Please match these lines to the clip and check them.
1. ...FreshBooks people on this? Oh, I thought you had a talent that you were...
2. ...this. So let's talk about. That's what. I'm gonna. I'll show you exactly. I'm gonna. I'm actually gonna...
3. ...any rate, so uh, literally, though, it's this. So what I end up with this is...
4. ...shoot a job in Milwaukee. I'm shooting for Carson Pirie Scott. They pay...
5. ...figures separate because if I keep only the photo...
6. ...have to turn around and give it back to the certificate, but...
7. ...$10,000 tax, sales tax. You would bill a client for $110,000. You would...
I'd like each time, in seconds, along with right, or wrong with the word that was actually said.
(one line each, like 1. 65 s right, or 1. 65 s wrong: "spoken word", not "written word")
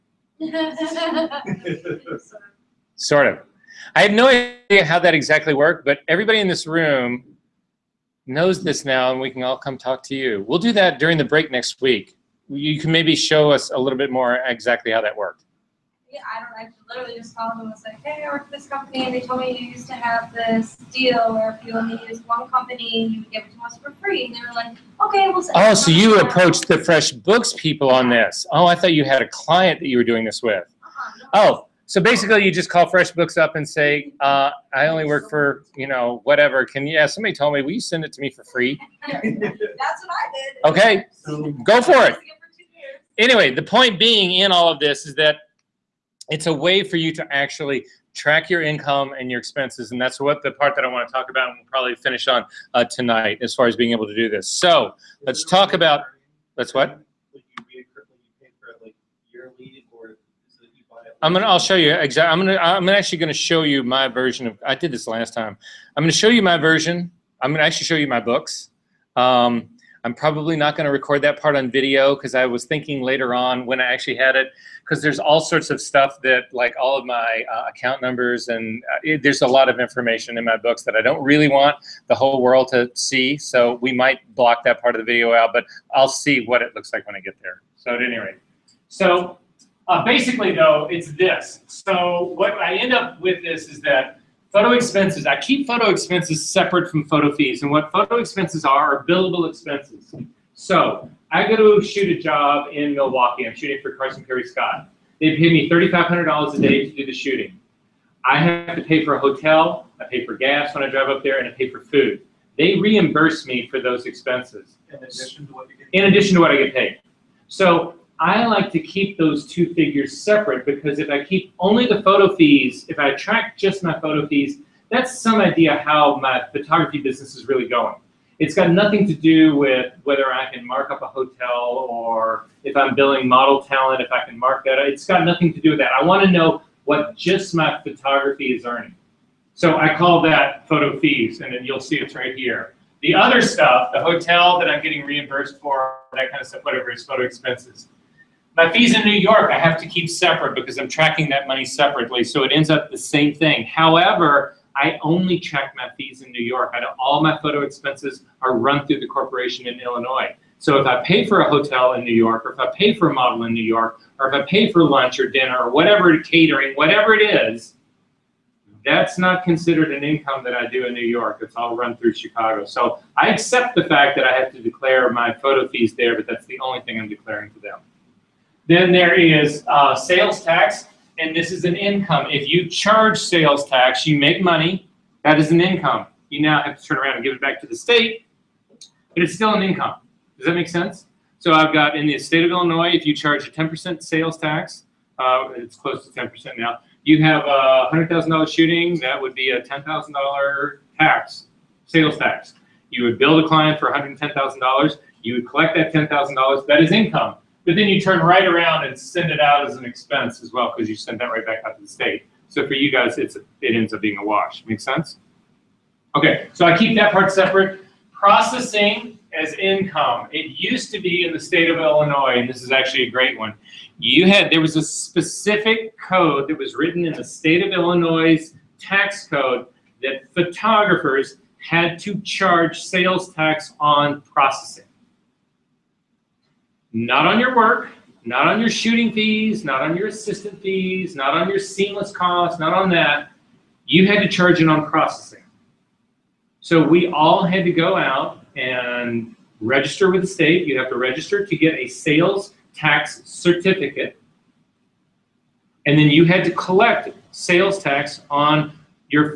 1. 26 s wrong: "client", not "talent"
2. 54 s right
3. 88 s wrong: "basically", not "literally"
4. 101 s right
5. 119 s right
6. 186 s wrong: "state", not "certificate"
7. 199 s right.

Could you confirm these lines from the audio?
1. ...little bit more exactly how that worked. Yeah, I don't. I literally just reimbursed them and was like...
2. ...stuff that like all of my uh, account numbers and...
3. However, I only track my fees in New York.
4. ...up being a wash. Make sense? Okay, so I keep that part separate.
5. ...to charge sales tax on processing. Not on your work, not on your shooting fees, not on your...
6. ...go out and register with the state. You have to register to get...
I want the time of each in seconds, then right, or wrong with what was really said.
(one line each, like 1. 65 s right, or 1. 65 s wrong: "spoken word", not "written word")
1. 13 s wrong: "called", not "reimbursed"
2. 75 s right
3. 153 s right
4. 213 s right
5. 231 s right
6. 247 s right.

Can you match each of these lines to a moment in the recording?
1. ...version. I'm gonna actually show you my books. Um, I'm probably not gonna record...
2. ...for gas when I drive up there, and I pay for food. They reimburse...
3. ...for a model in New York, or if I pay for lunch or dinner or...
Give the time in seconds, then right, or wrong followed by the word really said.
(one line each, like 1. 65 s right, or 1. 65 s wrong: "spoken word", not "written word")
1. 66 s right
2. 110 s right
3. 162 s right.